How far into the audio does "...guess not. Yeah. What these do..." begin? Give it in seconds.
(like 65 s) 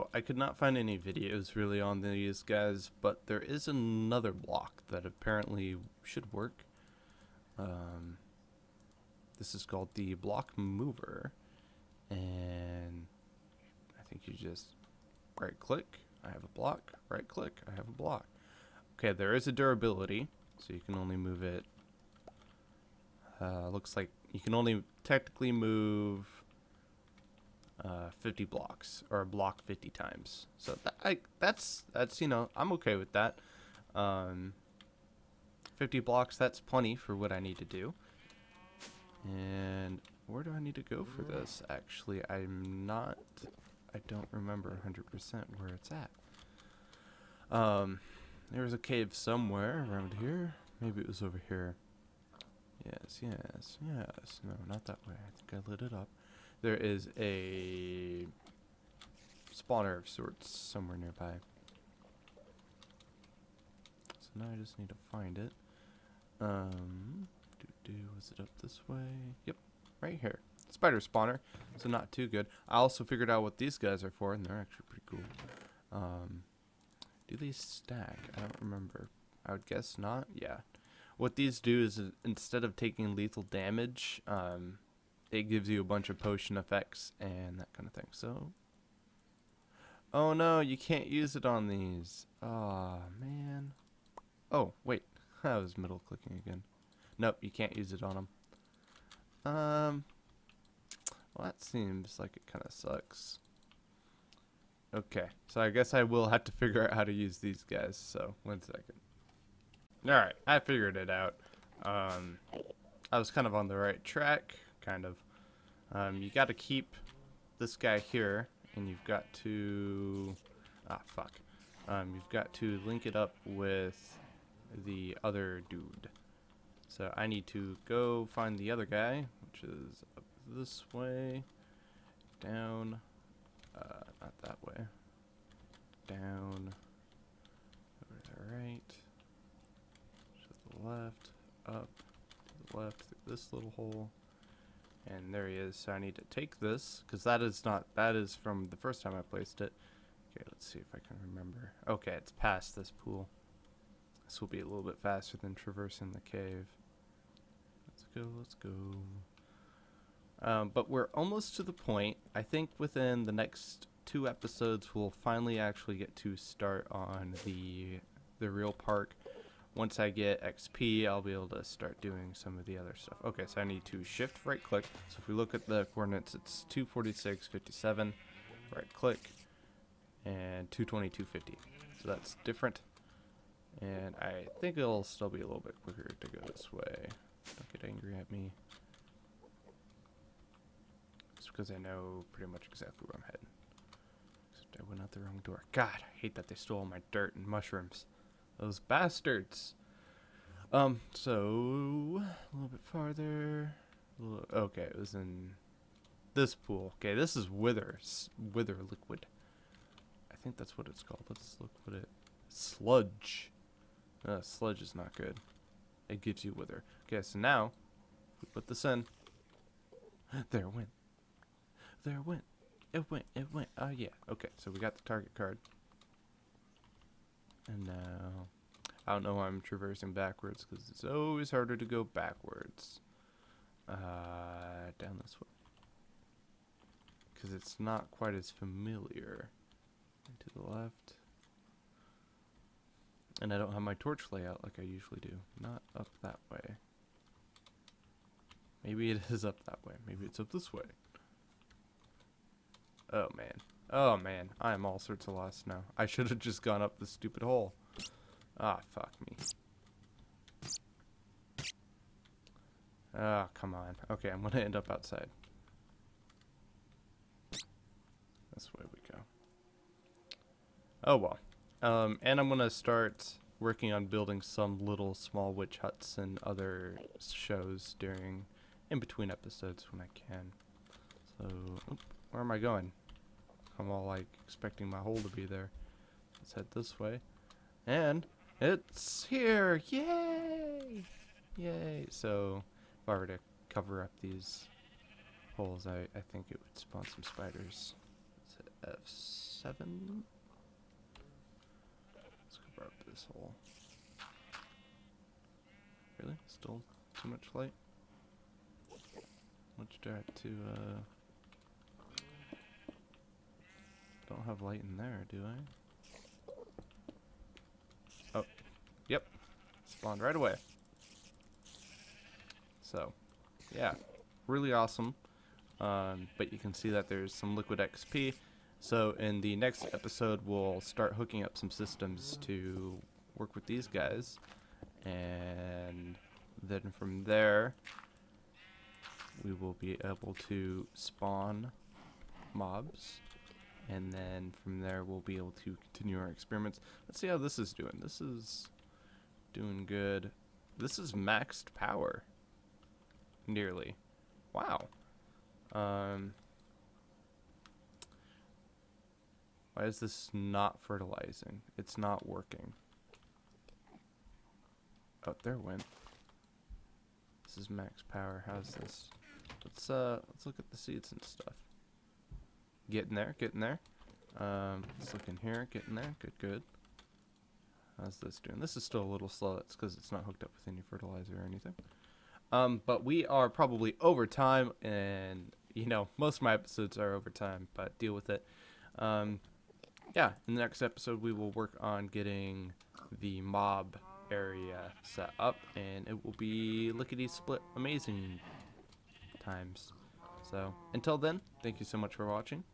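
79 s.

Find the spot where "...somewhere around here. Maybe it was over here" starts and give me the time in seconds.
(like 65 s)
49 s.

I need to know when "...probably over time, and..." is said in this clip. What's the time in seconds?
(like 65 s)
383 s.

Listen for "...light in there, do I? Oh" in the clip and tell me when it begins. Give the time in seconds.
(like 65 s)
314 s.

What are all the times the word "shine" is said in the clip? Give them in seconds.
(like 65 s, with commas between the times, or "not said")
not said.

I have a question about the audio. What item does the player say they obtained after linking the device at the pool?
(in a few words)
Target card.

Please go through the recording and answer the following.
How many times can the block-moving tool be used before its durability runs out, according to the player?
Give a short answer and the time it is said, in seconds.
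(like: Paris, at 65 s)
50, at 28 s.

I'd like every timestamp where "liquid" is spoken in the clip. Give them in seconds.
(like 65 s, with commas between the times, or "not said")
208 s, 327 s.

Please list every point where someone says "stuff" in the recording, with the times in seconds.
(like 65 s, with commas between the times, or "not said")
172 s, 371 s.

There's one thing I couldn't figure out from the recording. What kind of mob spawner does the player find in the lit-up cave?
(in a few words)
Spider.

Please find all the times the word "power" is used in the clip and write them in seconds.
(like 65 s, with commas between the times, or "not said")
351 s, 368 s.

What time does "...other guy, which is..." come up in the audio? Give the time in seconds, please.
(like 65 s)
128 s.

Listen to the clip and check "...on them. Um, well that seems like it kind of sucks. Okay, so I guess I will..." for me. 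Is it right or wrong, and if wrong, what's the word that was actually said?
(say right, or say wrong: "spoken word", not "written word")
right.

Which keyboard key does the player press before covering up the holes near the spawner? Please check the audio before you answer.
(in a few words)
F7.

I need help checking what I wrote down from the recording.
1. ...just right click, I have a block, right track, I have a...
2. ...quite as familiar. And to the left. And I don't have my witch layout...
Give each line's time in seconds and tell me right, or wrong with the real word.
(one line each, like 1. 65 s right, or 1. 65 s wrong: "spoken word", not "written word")
1. 14 s wrong: "click", not "track"
2. 238 s wrong: "torch", not "witch".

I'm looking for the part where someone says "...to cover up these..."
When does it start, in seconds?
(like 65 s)
293 s.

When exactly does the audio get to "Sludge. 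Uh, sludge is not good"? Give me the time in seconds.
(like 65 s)
212 s.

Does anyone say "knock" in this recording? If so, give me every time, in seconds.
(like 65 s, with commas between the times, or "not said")
not said.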